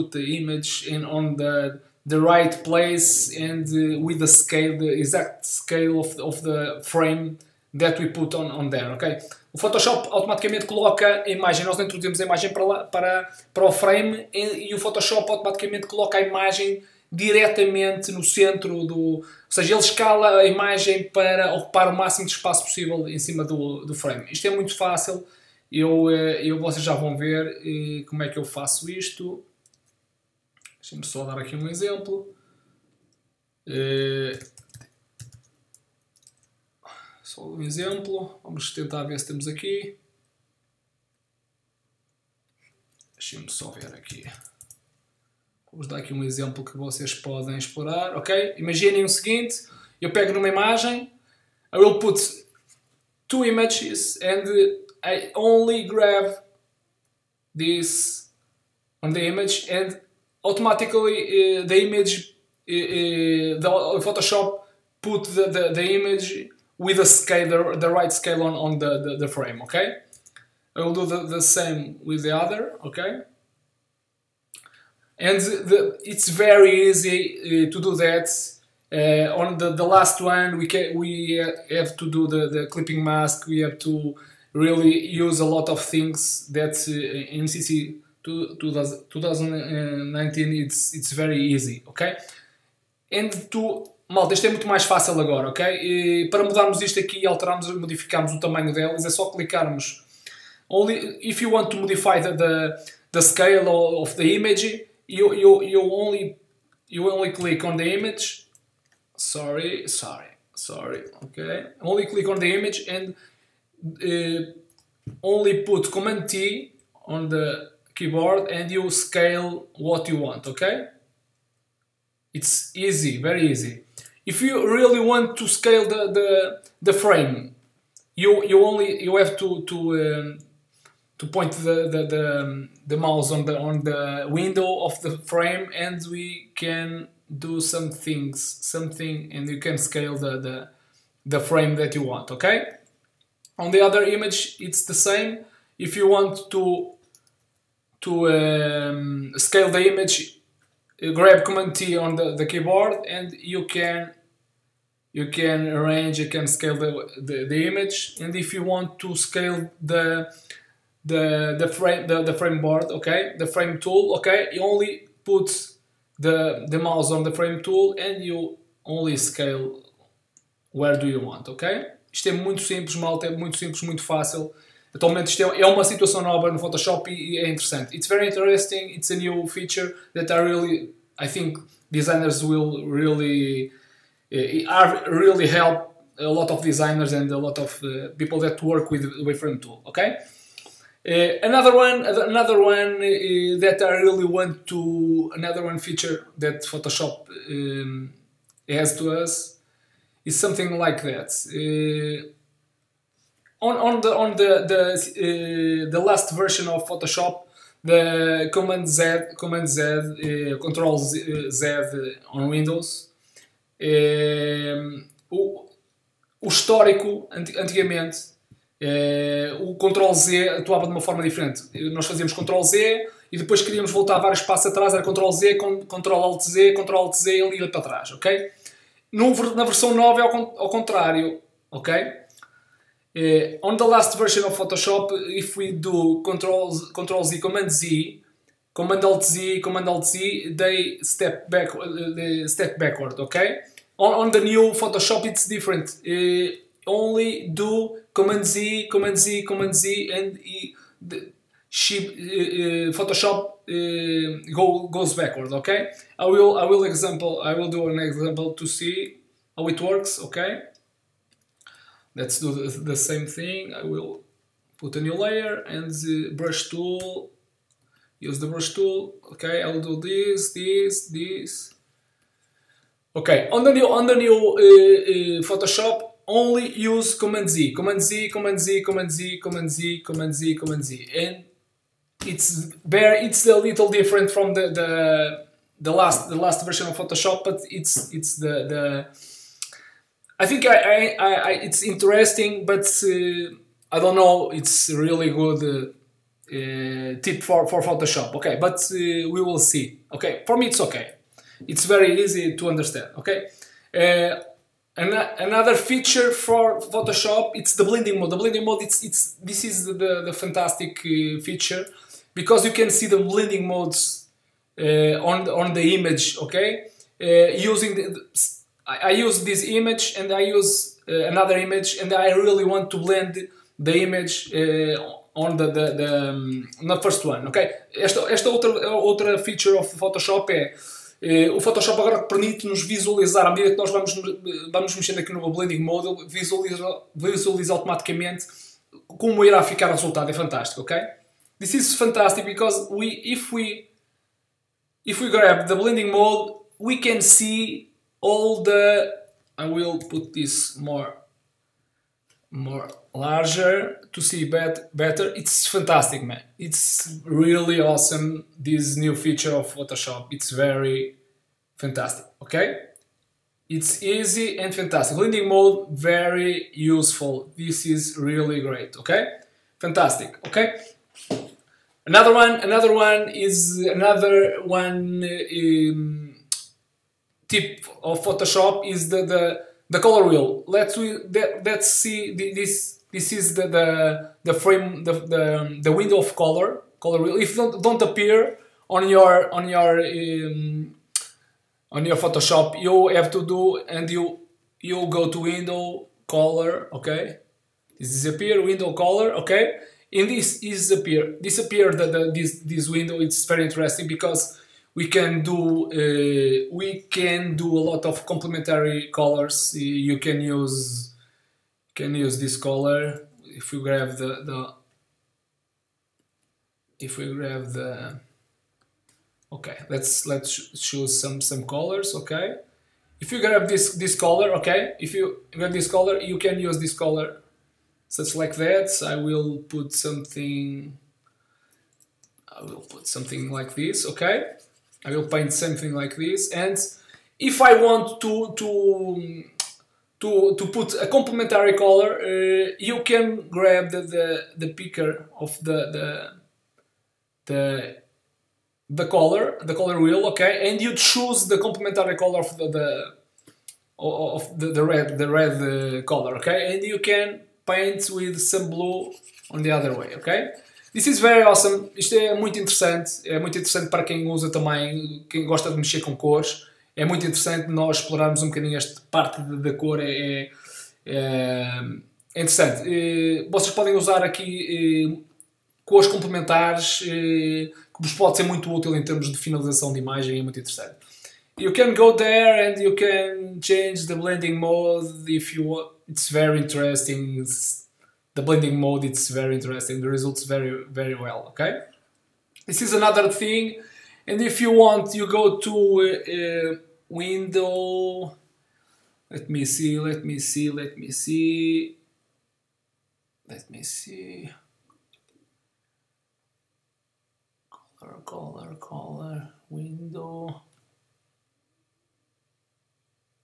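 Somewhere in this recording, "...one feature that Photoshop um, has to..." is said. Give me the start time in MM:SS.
03:15.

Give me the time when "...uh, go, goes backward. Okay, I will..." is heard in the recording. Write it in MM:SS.
04:13.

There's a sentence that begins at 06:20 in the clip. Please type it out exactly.
Let's we that, let's see this.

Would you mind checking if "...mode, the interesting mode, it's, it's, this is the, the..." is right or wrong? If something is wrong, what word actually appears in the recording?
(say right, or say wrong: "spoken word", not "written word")
wrong: "blending", not "interesting".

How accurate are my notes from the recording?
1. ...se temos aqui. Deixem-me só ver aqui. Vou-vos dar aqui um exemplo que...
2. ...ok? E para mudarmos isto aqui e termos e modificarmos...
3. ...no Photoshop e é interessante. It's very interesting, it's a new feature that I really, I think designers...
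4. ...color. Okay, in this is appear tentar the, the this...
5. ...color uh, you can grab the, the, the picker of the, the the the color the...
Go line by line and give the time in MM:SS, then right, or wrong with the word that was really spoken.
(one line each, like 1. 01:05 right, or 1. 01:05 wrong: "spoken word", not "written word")
1. 00:39 right
2. 01:35 wrong: "alterarmos", not "termos"
3. 02:56 right
4. 06:38 wrong: "disappear", not "tentar"
5. 07:21 right.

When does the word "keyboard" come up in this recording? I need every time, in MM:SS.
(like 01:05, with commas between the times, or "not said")
01:57, 02:32.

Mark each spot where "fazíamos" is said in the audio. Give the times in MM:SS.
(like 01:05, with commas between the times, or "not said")
03:42.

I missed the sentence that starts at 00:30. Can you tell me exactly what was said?
Deixem-me só dar aqui um exemplo.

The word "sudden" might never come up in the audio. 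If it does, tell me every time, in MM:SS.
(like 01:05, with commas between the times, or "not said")
not said.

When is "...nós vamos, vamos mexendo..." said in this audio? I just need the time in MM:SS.
05:33.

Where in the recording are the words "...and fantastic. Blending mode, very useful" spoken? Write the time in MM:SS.
06:04.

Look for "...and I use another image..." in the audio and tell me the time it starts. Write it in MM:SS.
05:20.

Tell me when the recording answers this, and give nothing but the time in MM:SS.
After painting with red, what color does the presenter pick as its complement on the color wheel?
07:38.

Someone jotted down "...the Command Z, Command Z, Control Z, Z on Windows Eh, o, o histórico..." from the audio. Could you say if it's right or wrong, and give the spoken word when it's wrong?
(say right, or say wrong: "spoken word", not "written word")
right.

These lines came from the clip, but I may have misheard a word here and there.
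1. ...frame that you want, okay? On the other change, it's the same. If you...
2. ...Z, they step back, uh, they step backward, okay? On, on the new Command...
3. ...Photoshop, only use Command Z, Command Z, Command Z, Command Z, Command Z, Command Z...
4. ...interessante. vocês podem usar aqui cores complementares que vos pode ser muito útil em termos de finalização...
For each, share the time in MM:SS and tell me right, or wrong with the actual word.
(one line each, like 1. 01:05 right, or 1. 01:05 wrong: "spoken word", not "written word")
1. 02:21 wrong: "image", not "change"
2. 04:00 wrong: "Photoshop", not "Command"
3. 04:35 right
4. 07:52 right.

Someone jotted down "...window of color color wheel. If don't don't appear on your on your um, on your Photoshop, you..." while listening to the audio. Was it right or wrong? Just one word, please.
right.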